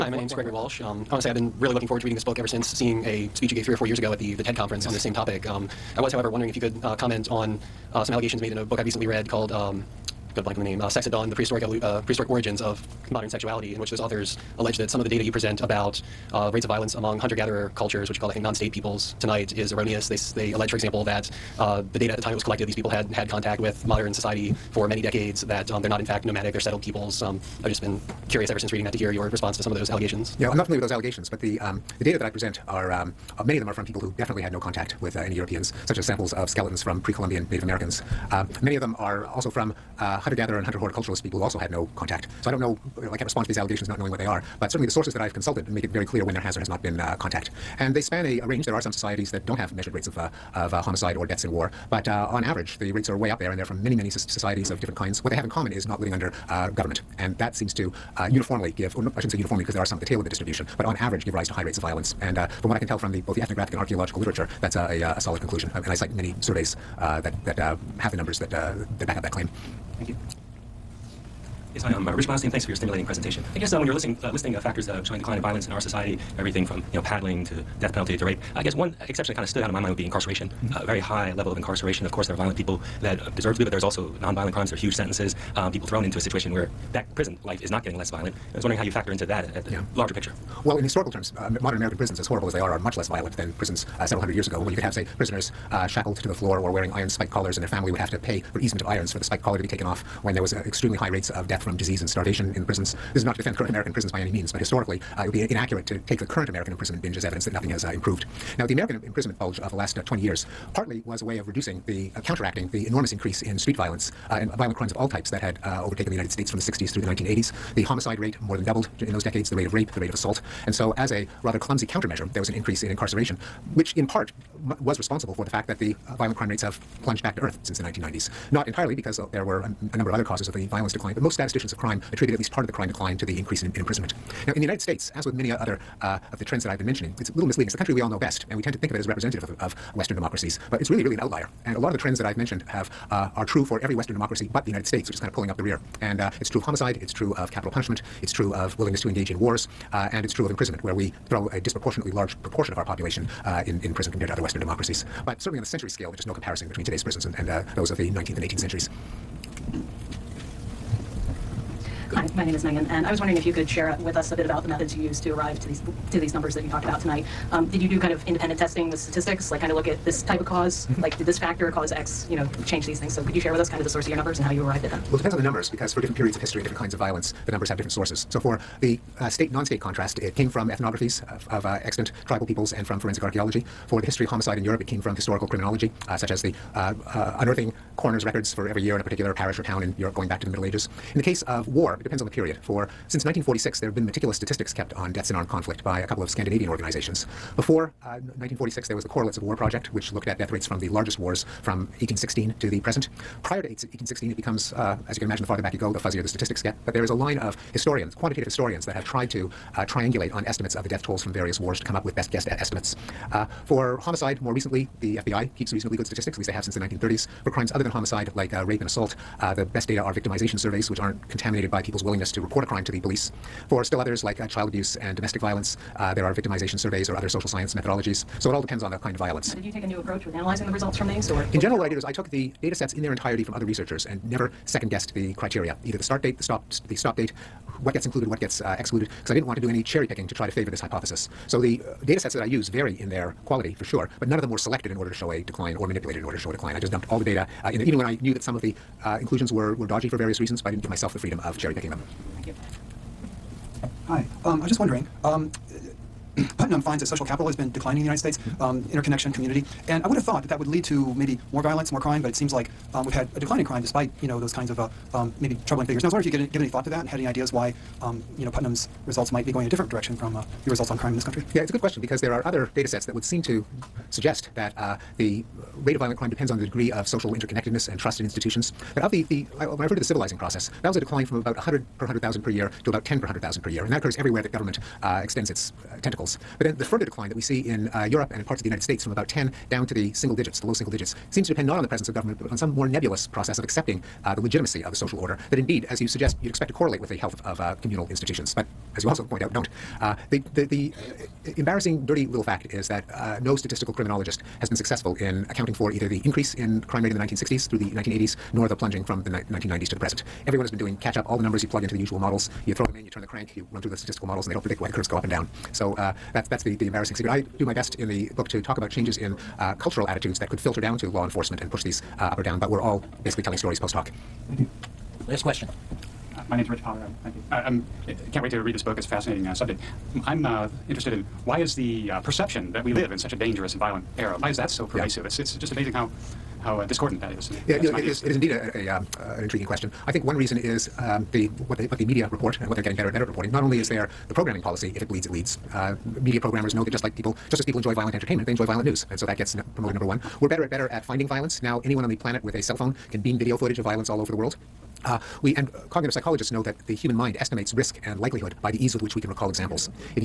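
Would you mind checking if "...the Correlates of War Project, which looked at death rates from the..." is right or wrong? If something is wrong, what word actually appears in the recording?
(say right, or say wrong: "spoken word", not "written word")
right.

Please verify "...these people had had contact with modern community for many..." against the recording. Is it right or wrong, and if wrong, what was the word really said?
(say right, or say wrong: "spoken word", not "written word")
wrong: "society", not "community".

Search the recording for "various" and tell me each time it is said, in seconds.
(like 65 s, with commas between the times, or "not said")
211 s, 250 s.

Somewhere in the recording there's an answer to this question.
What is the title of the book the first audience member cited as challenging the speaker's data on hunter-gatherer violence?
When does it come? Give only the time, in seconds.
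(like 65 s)
10 s.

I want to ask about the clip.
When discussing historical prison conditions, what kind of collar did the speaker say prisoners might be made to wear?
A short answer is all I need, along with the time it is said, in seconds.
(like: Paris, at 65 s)
iron spiked collars, at 96 s.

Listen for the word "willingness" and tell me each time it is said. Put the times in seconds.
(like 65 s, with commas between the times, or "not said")
148 s, 222 s.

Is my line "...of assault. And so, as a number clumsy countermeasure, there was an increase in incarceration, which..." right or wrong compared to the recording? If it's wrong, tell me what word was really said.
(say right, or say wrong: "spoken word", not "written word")
wrong: "rather", not "number".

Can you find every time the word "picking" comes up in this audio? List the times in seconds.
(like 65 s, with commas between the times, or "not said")
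240 s, 251 s.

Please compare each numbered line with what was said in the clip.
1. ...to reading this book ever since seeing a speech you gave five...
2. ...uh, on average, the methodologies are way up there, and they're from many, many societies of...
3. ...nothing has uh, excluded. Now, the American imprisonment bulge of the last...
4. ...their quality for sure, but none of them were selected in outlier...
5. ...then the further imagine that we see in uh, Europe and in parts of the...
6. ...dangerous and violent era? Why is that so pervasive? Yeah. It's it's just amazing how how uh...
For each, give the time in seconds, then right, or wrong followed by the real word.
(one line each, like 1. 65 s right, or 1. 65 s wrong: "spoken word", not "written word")
1. 2 s wrong: "three", not "five"
2. 52 s wrong: "rates", not "methodologies"
3. 107 s wrong: "improved", not "excluded"
4. 243 s wrong: "order", not "outlier"
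5. 286 s wrong: "decline", not "imagine"
6. 333 s right.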